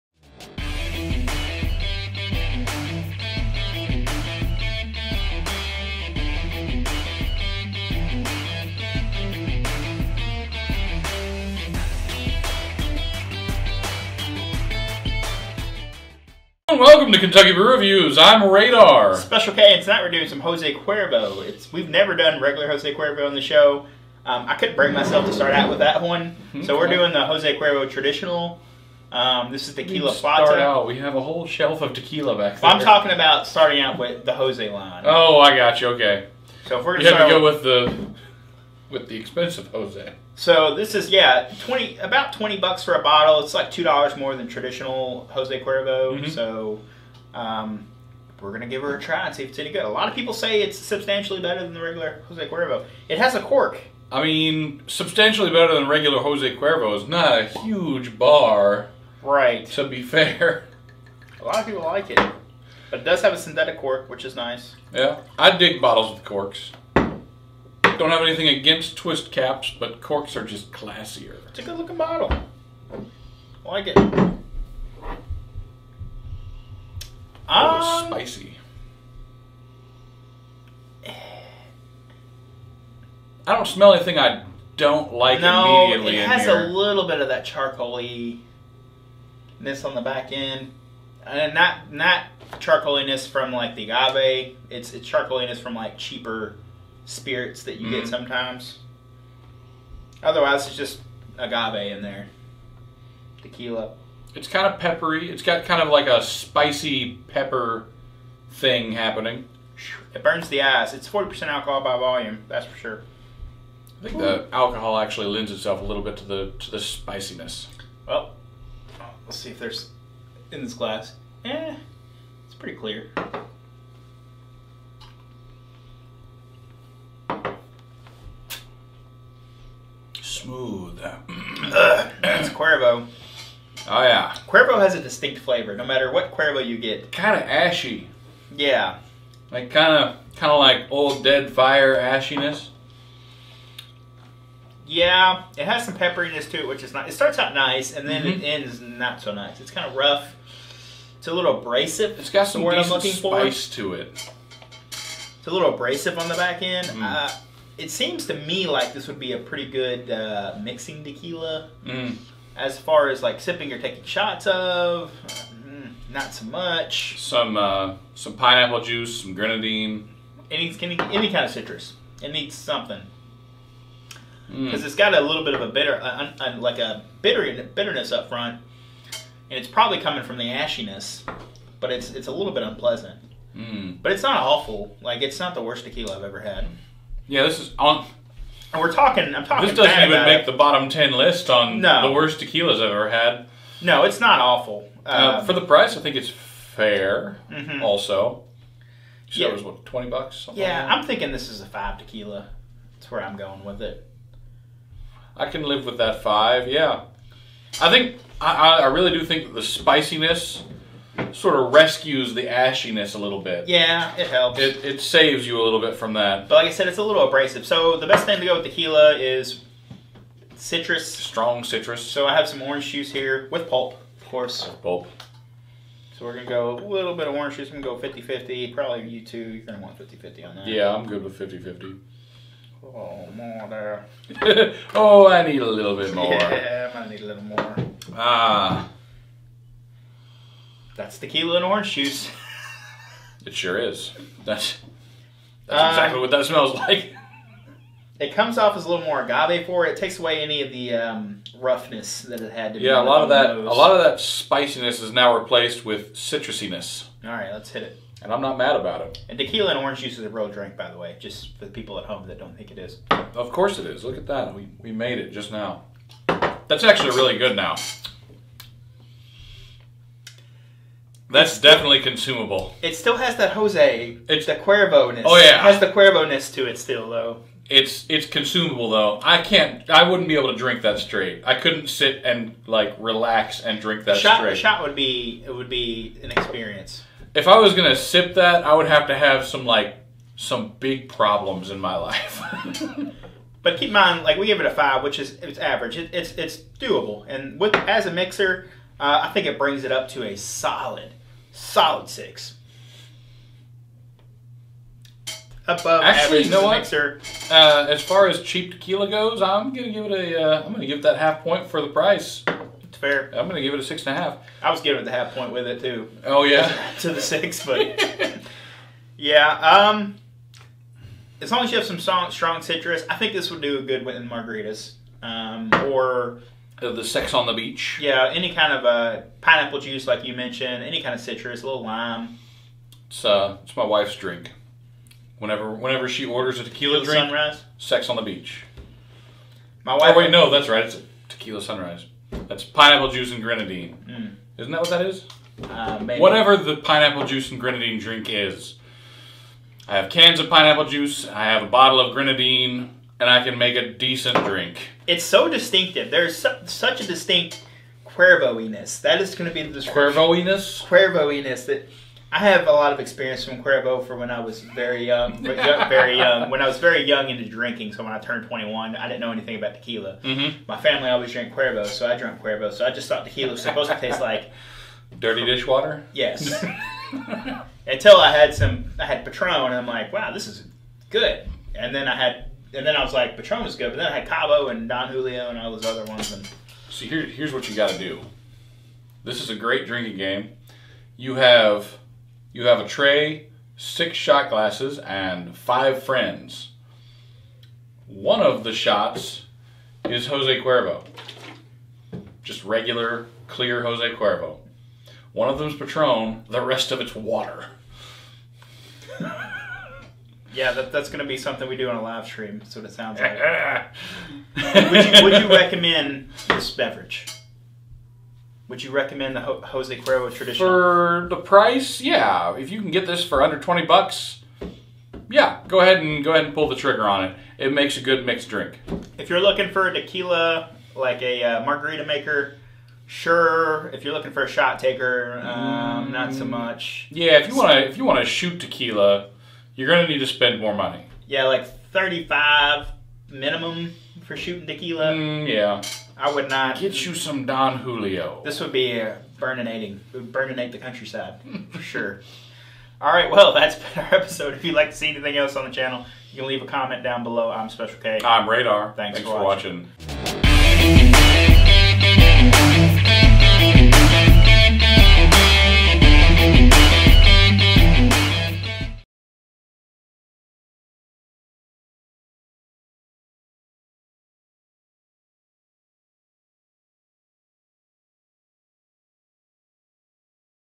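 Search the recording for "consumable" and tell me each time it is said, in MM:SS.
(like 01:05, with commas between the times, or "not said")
04:32, 04:38.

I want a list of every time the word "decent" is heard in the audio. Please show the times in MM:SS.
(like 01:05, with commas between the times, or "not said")
02:32, 05:53.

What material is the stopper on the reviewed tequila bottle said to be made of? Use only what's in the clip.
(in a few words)
Synthetic cork.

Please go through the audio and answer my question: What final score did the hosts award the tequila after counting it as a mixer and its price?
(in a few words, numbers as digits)
6.5.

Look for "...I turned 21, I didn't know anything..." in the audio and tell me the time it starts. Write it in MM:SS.
06:08.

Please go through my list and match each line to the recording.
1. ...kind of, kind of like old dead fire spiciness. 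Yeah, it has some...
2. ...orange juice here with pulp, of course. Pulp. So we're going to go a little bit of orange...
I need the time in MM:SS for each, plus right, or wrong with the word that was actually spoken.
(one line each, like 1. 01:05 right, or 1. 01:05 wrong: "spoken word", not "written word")
1. 02:19 wrong: "ashiness", not "spiciness"
2. 03:42 right.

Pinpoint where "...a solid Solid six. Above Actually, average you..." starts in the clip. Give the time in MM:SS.
05:00.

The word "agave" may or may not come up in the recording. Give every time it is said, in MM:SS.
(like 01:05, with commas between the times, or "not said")
01:33, 01:41, 04:09.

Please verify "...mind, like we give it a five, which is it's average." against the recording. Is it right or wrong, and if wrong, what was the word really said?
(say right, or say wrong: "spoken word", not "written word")
right.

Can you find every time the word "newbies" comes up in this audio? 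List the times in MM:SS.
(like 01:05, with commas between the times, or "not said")
not said.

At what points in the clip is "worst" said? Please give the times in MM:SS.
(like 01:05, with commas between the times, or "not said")
03:05, 03:12.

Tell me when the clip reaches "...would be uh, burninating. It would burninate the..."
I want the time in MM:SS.
07:28.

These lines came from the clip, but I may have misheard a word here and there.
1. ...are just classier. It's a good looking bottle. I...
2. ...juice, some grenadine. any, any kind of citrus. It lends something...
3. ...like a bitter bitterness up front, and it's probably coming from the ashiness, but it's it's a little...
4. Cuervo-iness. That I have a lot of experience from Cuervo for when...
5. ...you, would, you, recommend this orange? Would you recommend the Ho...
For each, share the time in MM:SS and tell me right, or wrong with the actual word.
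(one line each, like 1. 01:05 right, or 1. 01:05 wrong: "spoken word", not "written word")
1. 01:10 right
2. 02:48 wrong: "needs", not "lends"
3. 02:56 right
4. 06:00 right
5. 06:55 wrong: "beverage", not "orange".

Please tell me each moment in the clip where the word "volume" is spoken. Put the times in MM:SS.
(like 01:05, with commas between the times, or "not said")
01:51.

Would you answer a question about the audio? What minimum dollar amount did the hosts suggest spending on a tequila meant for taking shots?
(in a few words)
$35.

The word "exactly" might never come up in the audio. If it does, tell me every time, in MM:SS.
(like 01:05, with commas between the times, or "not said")
04:05.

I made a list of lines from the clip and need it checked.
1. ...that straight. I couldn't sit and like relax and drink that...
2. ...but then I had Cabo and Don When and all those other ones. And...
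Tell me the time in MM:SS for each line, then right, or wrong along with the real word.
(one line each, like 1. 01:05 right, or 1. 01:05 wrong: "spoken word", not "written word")
1. 04:40 right
2. 06:23 wrong: "Julio", not "When".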